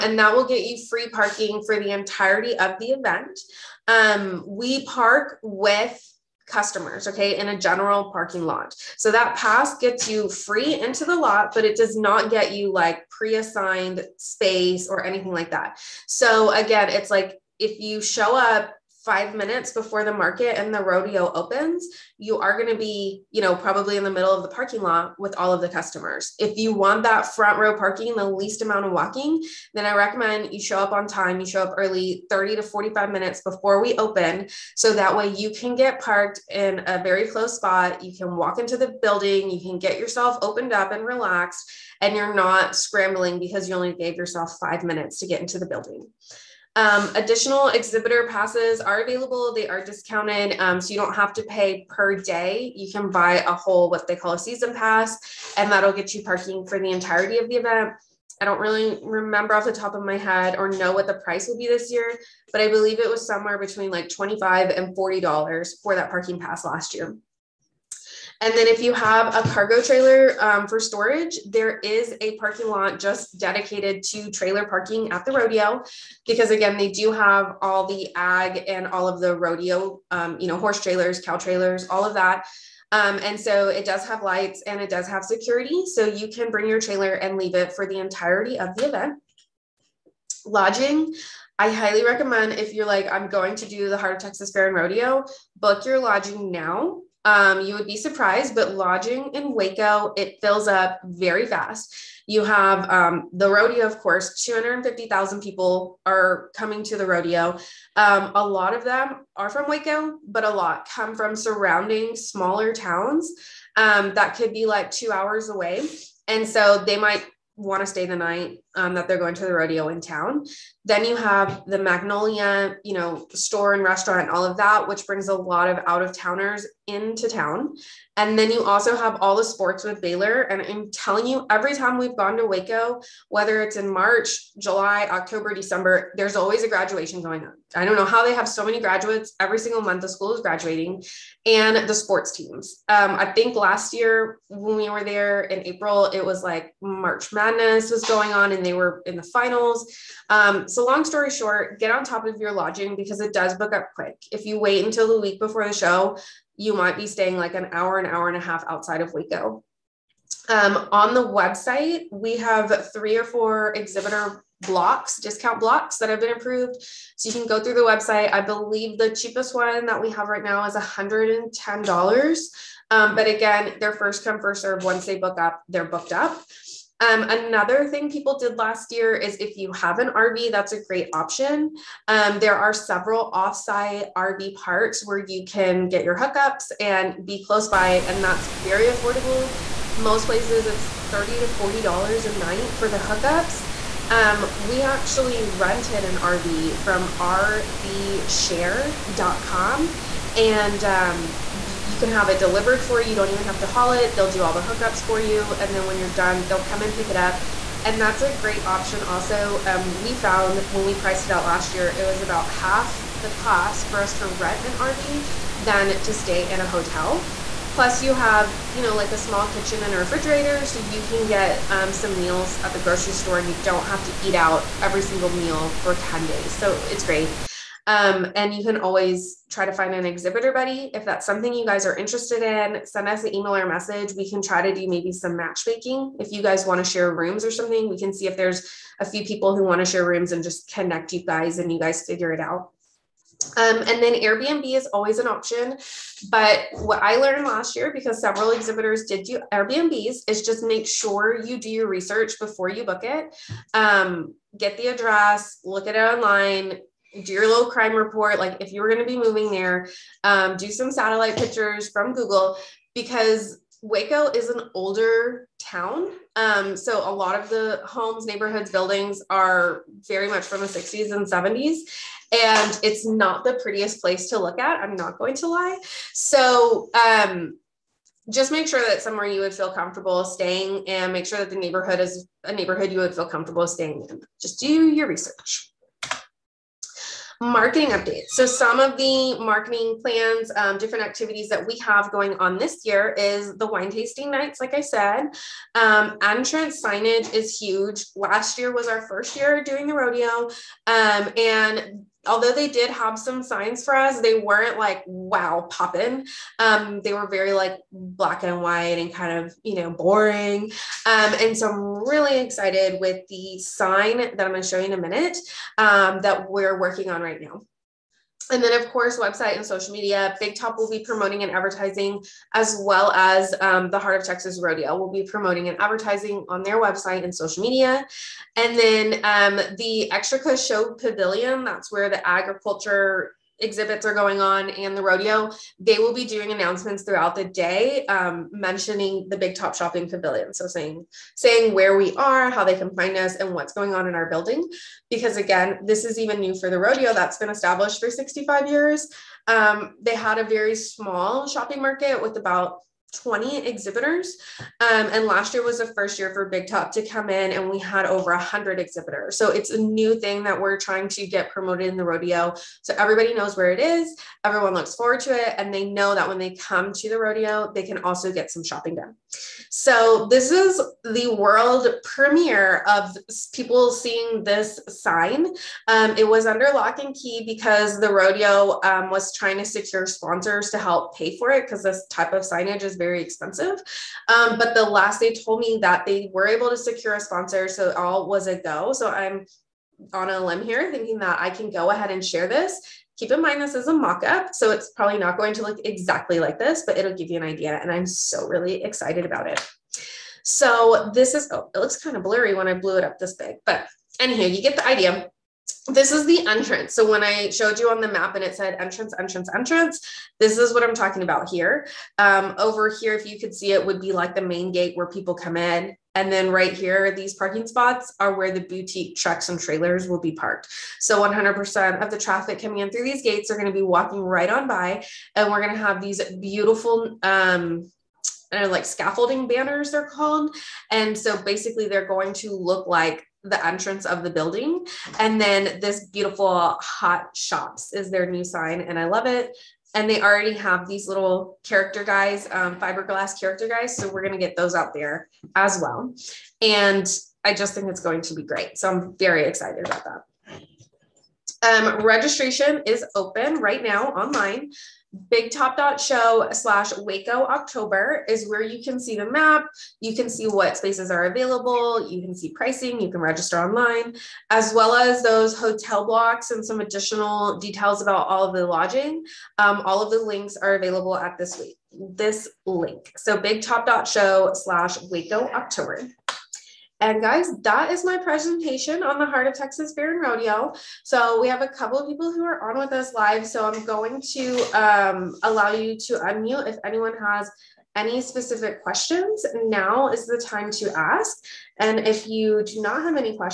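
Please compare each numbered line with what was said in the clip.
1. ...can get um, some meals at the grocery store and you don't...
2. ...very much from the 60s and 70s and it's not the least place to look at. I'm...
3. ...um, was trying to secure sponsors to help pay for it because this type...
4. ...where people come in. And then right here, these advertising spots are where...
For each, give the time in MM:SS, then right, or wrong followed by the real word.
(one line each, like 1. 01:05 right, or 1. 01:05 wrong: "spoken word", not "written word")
1. 03:41 right
2. 04:30 wrong: "prettiest", not "least"
3. 06:18 right
4. 06:54 wrong: "parking", not "advertising".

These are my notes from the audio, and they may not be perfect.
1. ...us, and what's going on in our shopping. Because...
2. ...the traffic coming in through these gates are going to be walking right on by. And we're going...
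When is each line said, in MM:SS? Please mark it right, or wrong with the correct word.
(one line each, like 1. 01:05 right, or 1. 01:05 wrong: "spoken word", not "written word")
1. 05:43 wrong: "building", not "shopping"
2. 07:02 right.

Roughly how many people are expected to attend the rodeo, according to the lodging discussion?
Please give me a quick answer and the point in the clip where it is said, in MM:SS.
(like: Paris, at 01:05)
250,000, at 01:44.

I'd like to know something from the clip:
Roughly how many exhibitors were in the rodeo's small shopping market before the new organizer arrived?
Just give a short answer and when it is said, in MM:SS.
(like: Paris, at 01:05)
20, at 05:53.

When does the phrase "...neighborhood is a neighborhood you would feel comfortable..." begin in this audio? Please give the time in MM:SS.
04:41.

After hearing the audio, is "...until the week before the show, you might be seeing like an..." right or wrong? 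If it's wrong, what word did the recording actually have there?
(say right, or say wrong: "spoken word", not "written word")
wrong: "staying", not "seeing".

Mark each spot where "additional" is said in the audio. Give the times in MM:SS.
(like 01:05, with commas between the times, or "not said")
00:47, 07:46.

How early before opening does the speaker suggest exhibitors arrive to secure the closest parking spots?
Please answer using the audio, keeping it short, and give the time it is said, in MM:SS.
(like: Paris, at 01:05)
30 to 45 minutes, at 00:32.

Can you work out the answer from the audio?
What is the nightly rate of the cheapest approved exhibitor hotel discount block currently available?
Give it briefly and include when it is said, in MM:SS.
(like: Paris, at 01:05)
$110, at 02:50.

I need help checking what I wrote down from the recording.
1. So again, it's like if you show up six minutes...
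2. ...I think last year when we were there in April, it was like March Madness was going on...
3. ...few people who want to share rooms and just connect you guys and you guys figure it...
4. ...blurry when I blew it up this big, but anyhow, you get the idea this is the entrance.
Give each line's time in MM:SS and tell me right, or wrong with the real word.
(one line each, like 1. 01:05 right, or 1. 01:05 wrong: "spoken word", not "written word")
1. 00:16 wrong: "five", not "six"
2. 02:23 right
3. 03:59 right
4. 06:42 right.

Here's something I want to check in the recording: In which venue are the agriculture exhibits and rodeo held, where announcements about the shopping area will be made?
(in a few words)
Extraco Show Pavilion.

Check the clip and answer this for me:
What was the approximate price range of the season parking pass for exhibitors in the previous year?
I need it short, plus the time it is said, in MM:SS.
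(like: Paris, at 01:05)
$25 to $40, at 01:04.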